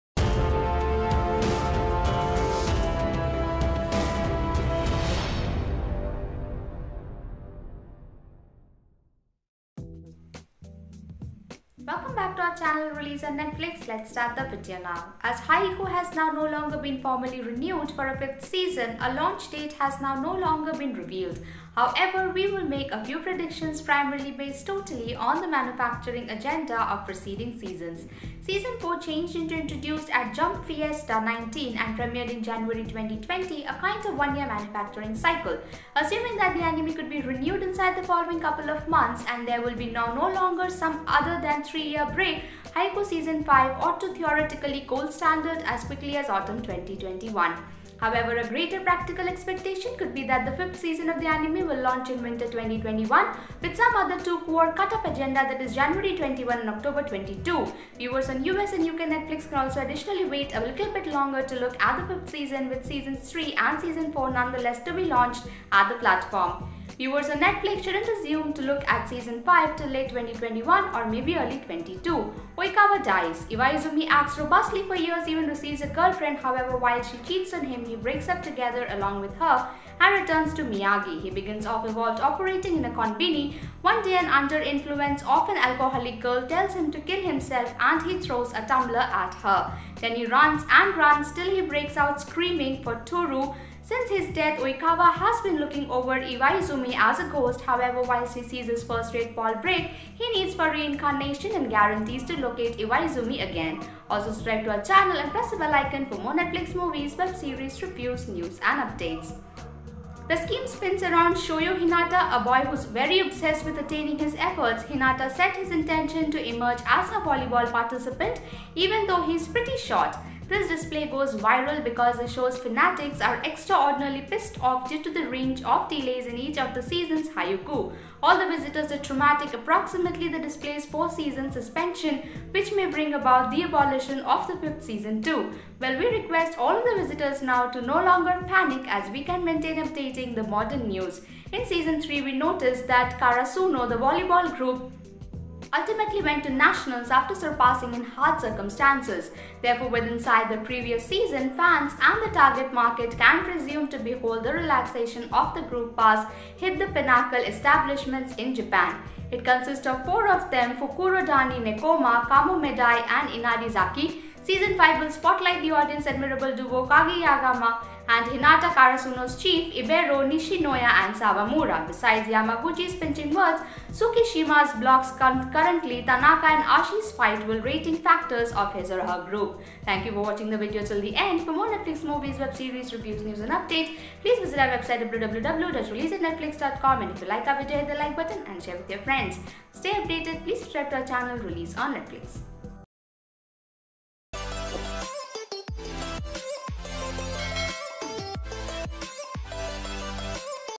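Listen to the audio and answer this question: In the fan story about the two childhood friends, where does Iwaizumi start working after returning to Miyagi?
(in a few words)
konbini.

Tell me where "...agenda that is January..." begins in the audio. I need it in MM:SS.
00:55.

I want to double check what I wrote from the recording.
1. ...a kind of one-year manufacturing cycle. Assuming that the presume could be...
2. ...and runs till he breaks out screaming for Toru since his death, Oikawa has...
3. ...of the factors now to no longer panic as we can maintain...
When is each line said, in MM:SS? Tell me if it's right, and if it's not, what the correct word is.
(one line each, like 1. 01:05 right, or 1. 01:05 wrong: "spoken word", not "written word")
1. 00:33 wrong: "anime", not "presume"
2. 01:30 right
3. 02:16 wrong: "visitors", not "factors".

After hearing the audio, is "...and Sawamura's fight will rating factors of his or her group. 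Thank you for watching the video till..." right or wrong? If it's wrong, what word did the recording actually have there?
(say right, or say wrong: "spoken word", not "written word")
wrong: "Asahi", not "Sawamura".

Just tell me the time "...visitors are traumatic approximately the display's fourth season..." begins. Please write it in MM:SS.
02:08.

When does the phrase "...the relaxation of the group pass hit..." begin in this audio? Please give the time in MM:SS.
02:34.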